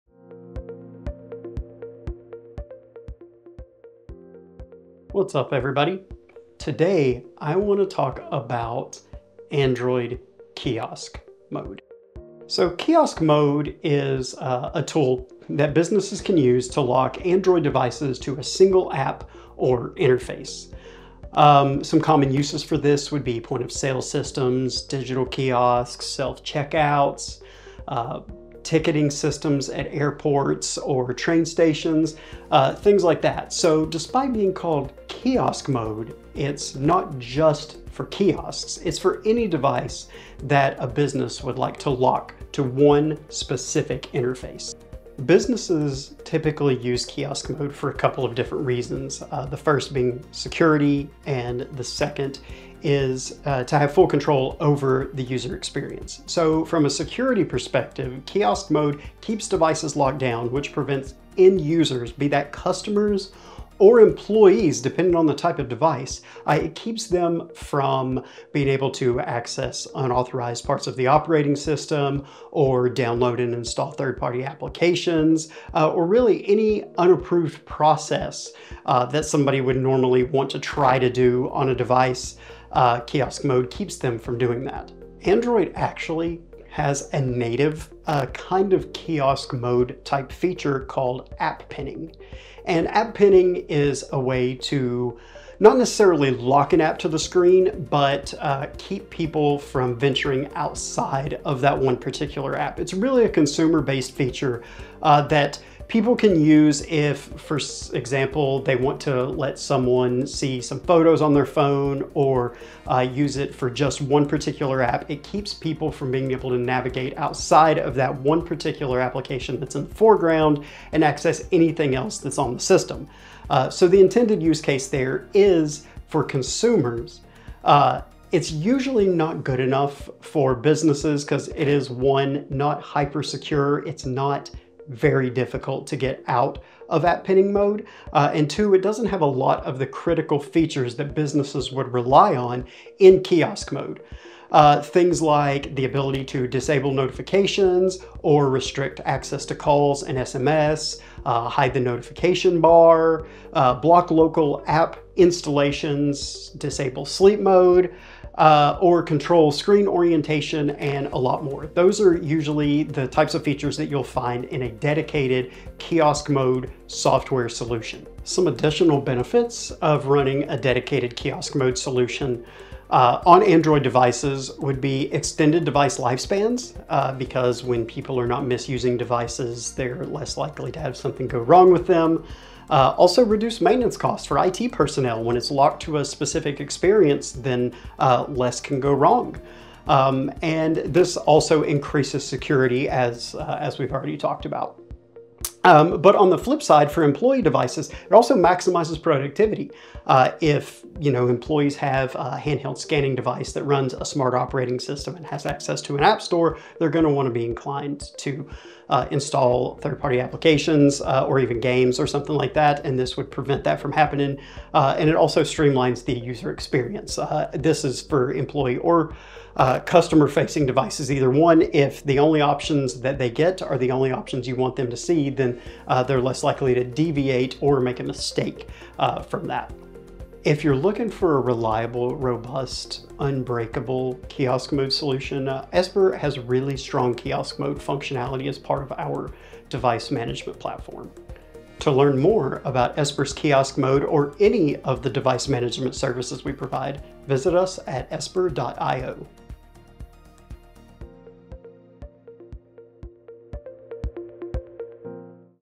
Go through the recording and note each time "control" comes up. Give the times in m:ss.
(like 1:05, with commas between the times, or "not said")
0:54, 2:39.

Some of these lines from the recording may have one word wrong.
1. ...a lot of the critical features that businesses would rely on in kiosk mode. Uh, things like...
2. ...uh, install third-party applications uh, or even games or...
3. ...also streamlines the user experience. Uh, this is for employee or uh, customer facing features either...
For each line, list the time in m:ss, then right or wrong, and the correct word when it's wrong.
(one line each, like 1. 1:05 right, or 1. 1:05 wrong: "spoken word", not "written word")
1. 2:19 right
2. 3:28 right
3. 3:35 wrong: "devices", not "features".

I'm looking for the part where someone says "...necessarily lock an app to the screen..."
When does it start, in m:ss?
1:35.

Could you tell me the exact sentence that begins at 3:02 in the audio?
Uh, also reduce maintenance costs for IT personnel.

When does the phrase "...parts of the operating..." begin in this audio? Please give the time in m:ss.
1:10.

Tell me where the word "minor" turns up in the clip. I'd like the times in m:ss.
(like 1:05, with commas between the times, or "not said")
not said.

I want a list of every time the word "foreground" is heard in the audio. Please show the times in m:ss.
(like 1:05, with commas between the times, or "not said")
1:59.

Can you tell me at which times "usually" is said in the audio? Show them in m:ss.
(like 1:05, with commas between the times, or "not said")
2:08, 2:42.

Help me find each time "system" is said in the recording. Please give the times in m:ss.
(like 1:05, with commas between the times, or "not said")
0:24, 0:29, 1:11, 2:02, 3:24.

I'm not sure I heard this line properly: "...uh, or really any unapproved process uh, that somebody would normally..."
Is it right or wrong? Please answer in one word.
right.